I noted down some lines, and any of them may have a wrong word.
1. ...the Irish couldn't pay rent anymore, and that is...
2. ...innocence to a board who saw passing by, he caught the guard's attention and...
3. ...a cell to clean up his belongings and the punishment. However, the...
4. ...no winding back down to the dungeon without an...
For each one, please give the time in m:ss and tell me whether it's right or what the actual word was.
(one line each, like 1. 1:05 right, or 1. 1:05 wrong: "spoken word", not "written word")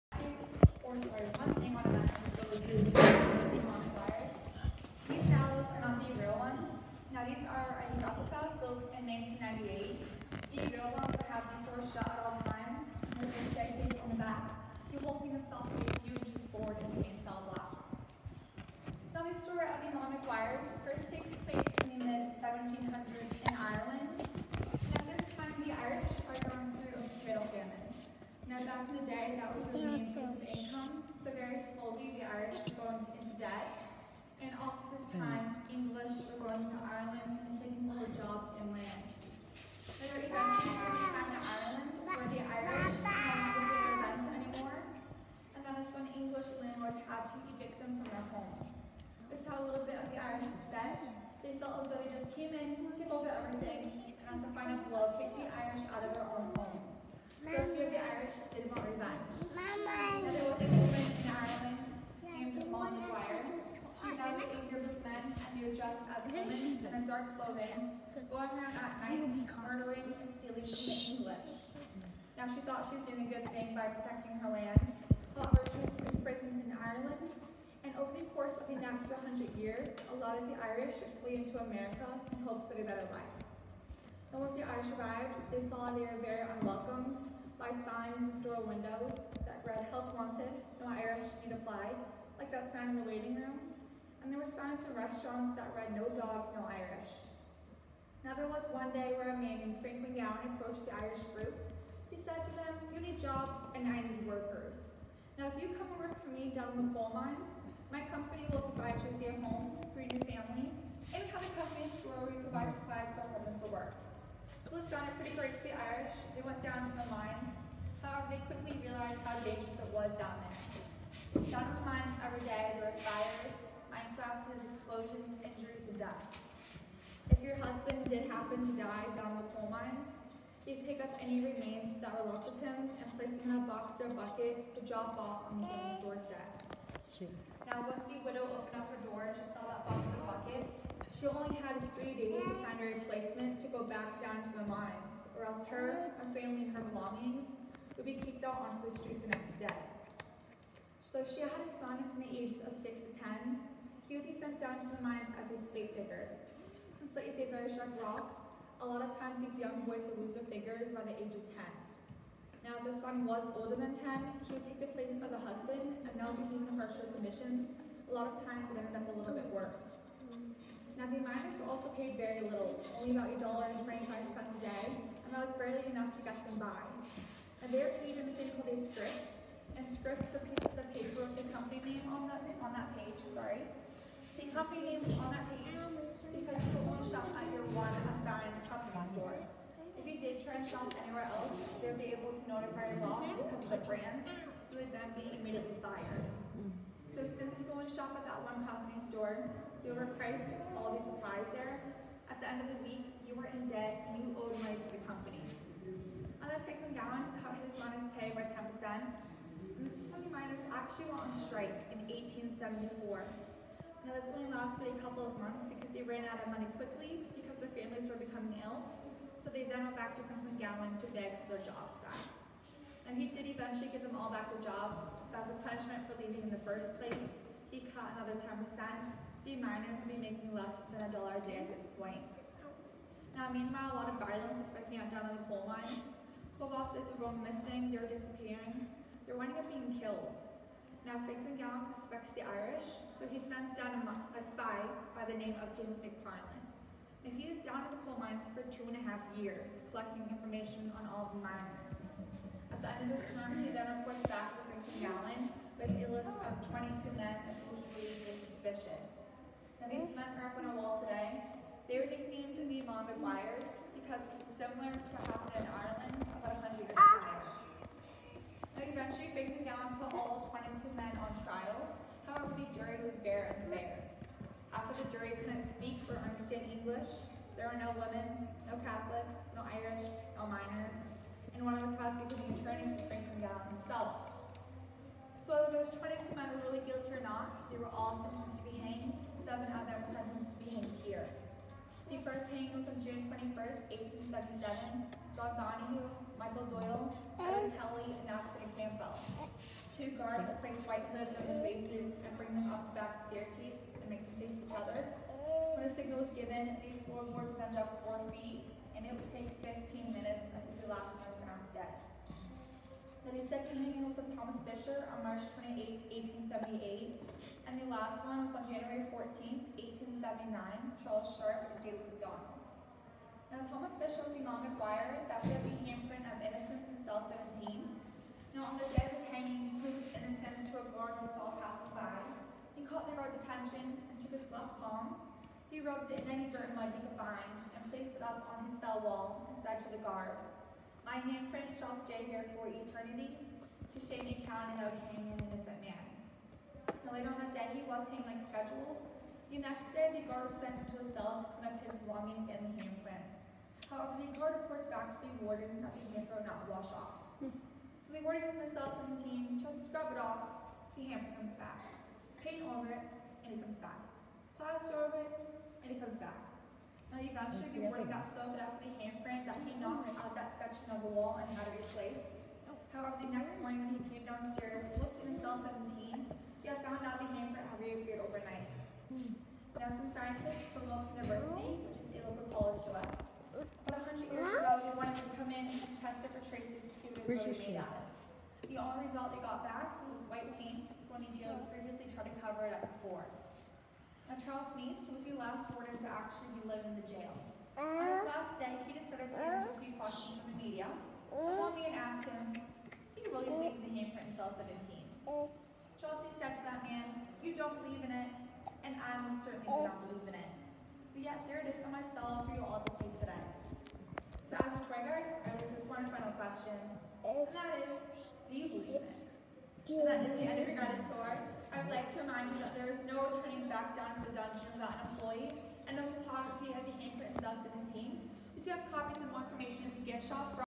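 1. 0:42 right
2. 5:30 wrong: "guard", not "board"
3. 5:51 wrong: "handprint", not "punishment"
4. 7:03 wrong: "turning", not "winding".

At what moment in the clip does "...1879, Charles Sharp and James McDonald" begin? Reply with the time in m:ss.
5:20.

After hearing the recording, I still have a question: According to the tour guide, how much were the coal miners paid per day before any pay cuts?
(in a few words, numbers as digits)
$1.25.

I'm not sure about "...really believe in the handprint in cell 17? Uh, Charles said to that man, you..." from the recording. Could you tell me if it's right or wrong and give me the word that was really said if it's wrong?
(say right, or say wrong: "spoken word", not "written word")
right.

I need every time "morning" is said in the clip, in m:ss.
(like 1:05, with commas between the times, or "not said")
6:13.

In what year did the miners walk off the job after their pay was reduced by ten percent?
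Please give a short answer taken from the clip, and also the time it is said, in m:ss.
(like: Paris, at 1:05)
1874, at 3:32.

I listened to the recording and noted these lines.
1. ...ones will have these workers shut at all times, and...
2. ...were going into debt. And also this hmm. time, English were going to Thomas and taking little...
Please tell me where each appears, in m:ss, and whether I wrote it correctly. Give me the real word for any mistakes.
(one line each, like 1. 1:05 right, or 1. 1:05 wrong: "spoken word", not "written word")
1. 0:10 wrong: "doors", not "workers"
2. 0:32 wrong: "Ireland", not "Thomas".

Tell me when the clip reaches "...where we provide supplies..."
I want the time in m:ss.
1:52.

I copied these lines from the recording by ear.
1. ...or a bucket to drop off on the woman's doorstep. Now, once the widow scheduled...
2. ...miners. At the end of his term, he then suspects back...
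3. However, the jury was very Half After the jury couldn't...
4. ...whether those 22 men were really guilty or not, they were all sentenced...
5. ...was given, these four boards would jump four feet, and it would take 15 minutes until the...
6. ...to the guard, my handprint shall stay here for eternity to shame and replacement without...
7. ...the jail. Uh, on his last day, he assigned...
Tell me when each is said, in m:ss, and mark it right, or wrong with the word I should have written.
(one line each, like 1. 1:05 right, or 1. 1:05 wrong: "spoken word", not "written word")
1. 2:13 wrong: "opened", not "scheduled"
2. 4:11 wrong: "reports", not "suspects"
3. 4:32 right
4. 4:45 right
5. 5:06 right
6. 5:39 wrong: "count", not "replacement"
7. 6:37 wrong: "decided", not "assigned".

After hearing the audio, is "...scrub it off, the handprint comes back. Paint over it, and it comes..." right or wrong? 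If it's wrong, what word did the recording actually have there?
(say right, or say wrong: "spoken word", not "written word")
right.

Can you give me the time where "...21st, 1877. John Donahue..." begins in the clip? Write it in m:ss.
4:53.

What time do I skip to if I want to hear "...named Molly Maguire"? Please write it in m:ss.
1:02.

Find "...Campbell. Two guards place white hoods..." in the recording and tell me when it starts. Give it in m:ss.
4:58.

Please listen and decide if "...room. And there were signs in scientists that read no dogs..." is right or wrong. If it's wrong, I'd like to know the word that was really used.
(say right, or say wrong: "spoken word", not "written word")
wrong: "restaurants", not "scientists".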